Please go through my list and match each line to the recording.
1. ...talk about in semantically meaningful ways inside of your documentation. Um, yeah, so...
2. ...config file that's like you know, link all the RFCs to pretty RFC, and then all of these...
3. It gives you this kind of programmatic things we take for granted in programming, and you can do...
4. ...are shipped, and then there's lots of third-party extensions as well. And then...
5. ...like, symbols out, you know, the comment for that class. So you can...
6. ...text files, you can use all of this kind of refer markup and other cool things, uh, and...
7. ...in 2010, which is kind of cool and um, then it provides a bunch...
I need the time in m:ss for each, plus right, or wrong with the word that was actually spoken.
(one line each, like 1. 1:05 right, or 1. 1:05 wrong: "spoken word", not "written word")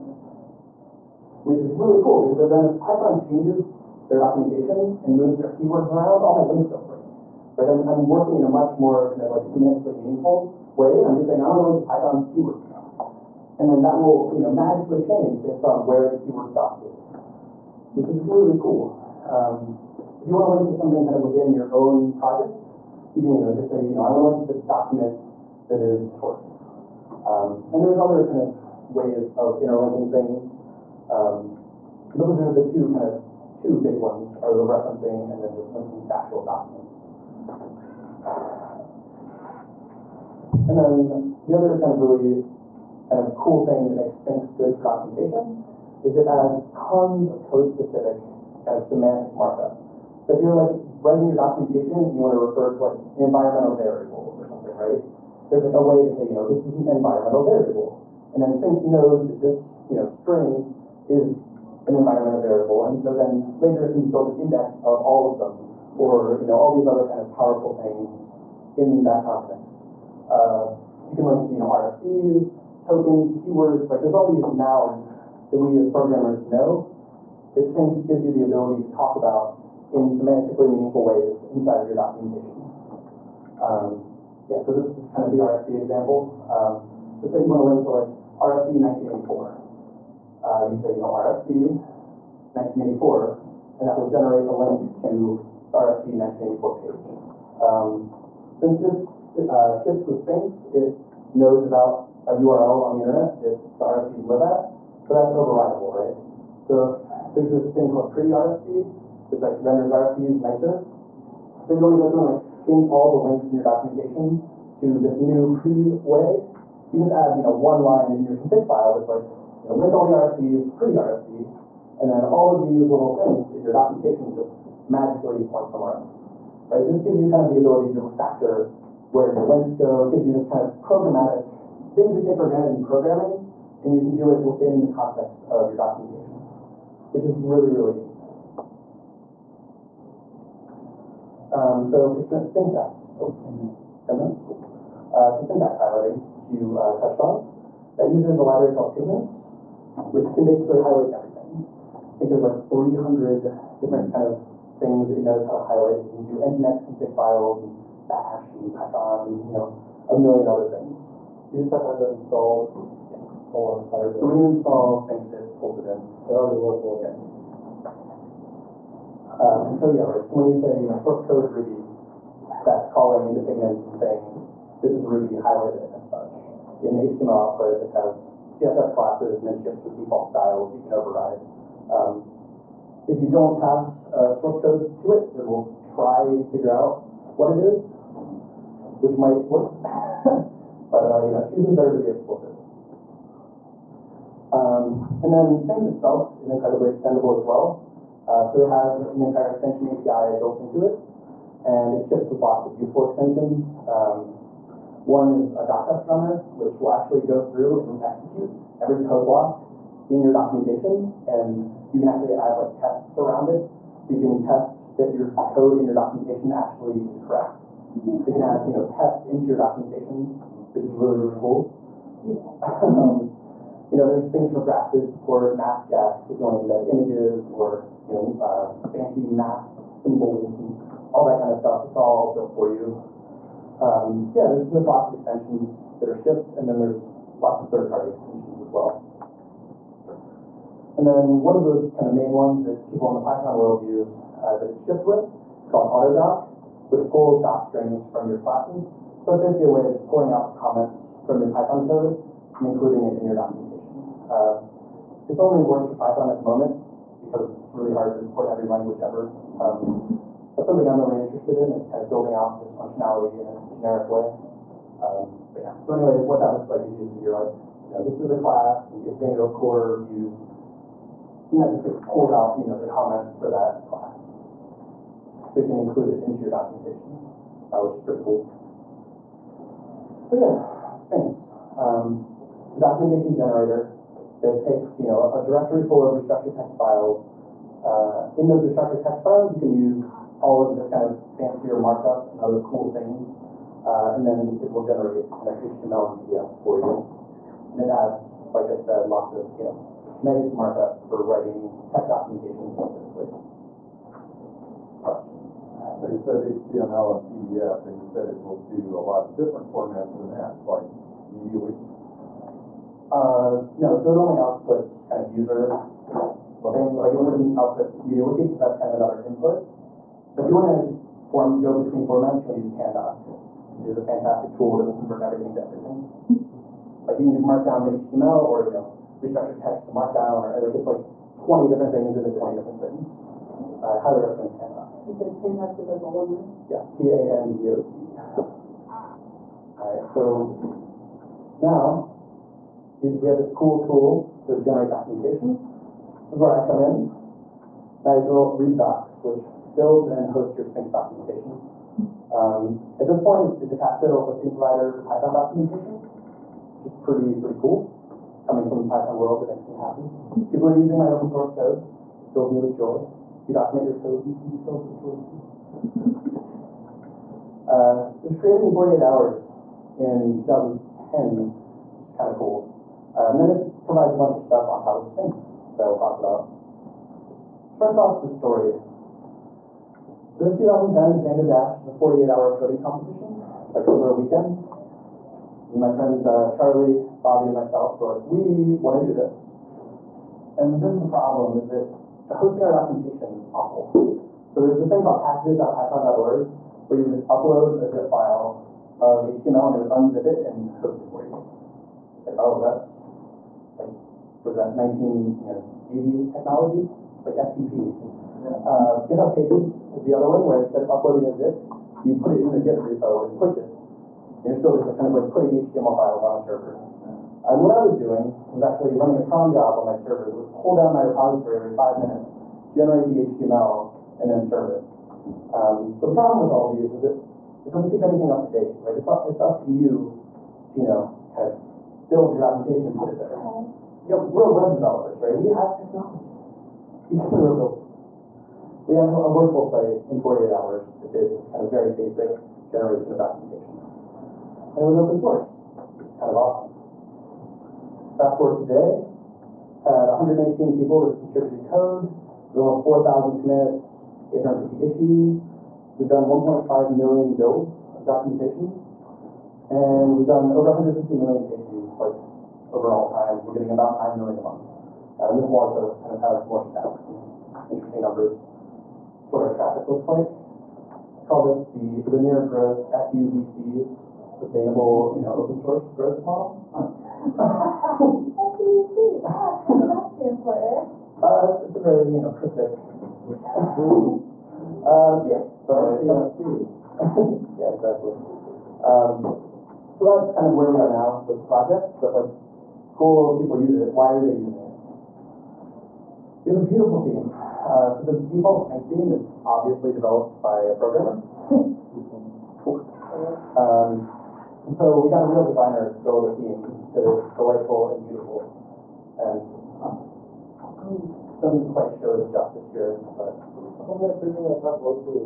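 1. 1:18 right
2. 1:58 right
3. 2:10 right
4. 3:56 right
5. 4:31 wrong: "pulls", not "symbols"
6. 4:49 wrong: "fancier", not "refer"
7. 6:09 right.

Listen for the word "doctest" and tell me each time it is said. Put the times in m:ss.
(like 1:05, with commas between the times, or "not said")
3:25.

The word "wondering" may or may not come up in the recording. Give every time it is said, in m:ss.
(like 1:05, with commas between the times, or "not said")
not said.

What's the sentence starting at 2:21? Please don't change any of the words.
Um, so for syntax, oh, 10 minutes, cool.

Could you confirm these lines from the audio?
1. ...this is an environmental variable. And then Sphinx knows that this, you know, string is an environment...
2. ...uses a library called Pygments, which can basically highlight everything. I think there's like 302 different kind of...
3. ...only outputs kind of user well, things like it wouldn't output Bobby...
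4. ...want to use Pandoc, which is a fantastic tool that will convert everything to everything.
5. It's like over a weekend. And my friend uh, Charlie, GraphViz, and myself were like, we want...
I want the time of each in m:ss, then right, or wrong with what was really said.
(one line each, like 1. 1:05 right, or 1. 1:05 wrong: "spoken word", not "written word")
1. 0:56 right
2. 2:28 wrong: "300", not "302"
3. 5:14 wrong: "MediaWiki", not "Bobby"
4. 5:22 right
5. 6:23 wrong: "Bobby", not "GraphViz".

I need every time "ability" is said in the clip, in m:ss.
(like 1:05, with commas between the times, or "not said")
1:18, 2:07.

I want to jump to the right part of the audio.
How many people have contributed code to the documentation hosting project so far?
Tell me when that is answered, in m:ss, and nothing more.
7:30.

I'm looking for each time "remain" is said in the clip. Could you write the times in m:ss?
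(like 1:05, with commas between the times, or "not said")
not said.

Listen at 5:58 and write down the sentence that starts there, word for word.
Coming from the Python world, it makes me happy.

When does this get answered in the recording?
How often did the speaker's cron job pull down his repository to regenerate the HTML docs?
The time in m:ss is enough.
7:01.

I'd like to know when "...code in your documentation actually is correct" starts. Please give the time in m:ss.
3:35.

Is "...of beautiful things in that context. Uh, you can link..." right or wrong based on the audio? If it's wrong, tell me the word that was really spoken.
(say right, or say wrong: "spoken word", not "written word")
wrong: "powerful", not "beautiful".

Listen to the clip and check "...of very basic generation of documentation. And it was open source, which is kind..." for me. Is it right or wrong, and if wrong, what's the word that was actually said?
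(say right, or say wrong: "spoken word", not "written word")
right.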